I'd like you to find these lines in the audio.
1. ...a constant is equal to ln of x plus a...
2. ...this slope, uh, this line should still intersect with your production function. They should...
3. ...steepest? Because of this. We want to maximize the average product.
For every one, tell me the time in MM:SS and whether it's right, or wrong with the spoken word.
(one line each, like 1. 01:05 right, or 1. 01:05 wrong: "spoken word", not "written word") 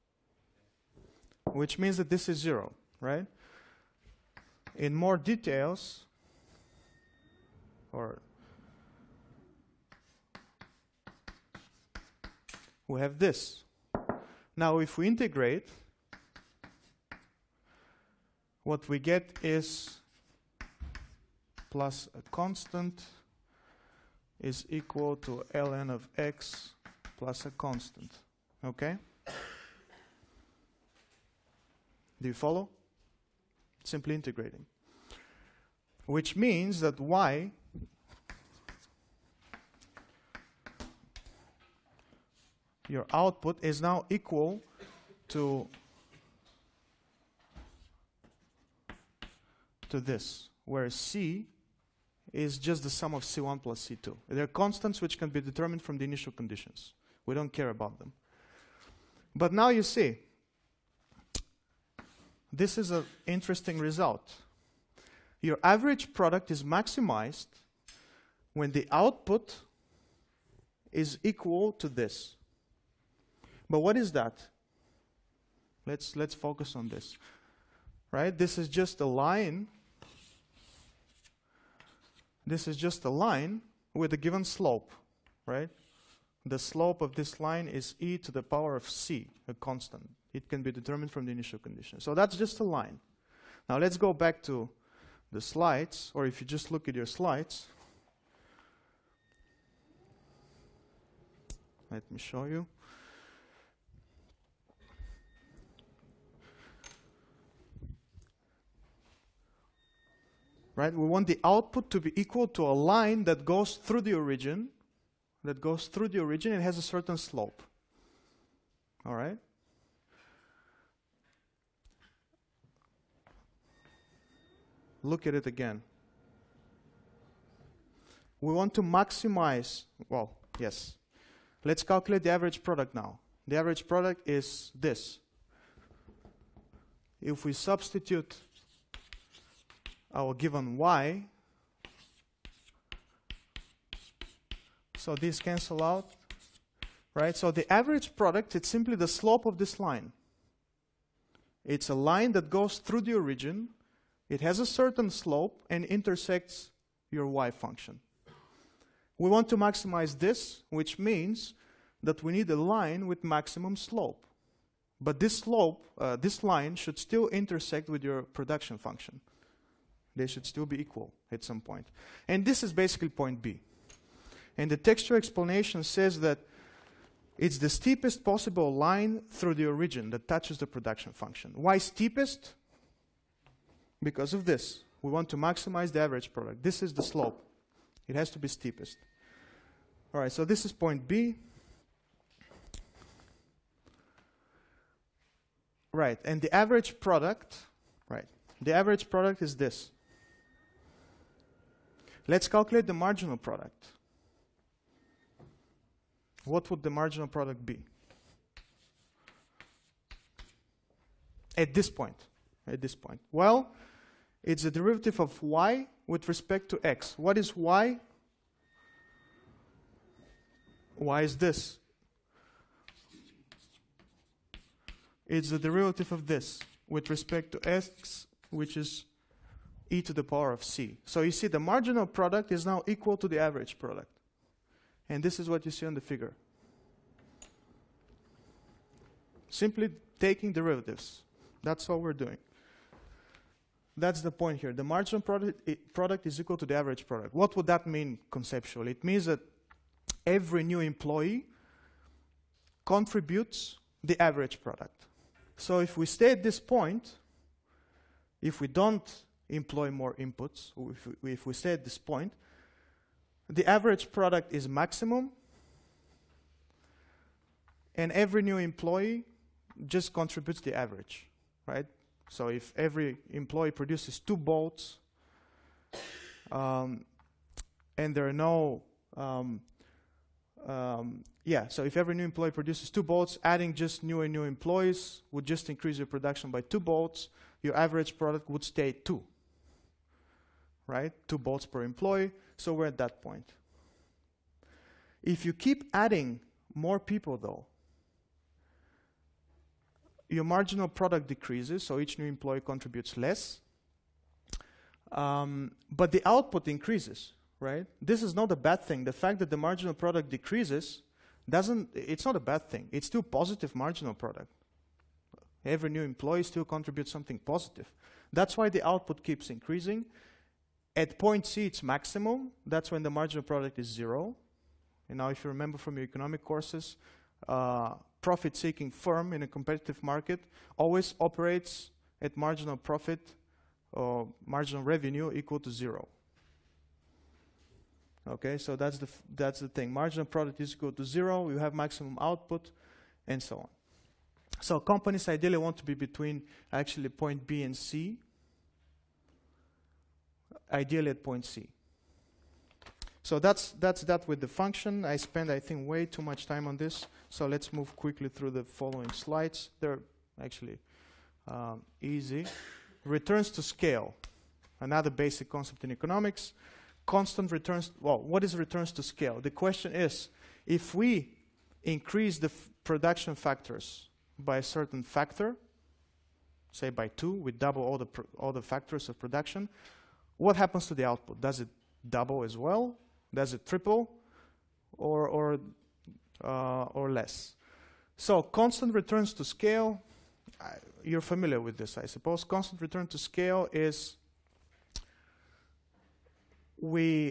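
1. 00:22 right
2. 02:45 right
3. 03:01 right.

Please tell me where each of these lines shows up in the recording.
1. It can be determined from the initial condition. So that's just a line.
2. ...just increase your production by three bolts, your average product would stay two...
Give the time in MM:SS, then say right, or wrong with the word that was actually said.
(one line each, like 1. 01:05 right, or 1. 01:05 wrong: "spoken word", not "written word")
1. 01:30 right
2. 04:45 wrong: "two", not "three".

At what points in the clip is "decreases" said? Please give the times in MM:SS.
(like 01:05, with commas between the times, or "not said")
05:01, 05:10.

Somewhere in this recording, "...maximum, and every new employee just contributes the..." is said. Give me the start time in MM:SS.
04:24.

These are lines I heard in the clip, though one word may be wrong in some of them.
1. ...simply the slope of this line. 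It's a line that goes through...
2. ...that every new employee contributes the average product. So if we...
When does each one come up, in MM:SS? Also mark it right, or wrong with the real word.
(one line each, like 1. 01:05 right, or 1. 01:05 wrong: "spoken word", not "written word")
1. 02:28 right
2. 04:09 right.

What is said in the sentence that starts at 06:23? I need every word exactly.
Does it triple or, or, uh, or less?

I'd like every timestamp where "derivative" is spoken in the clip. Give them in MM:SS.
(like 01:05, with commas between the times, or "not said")
03:34, 03:45, 04:00.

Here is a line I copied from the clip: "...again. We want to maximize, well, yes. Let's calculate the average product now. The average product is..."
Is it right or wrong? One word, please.
right.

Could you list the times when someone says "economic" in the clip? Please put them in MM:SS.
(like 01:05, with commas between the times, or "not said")
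05:26, 06:05.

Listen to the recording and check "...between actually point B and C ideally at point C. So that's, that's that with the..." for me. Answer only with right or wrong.
right.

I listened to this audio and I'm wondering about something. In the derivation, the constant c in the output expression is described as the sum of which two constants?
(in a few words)
C1 plus C2.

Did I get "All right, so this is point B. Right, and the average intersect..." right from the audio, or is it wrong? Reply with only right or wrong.
wrong.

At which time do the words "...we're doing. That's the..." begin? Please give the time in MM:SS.
04:01.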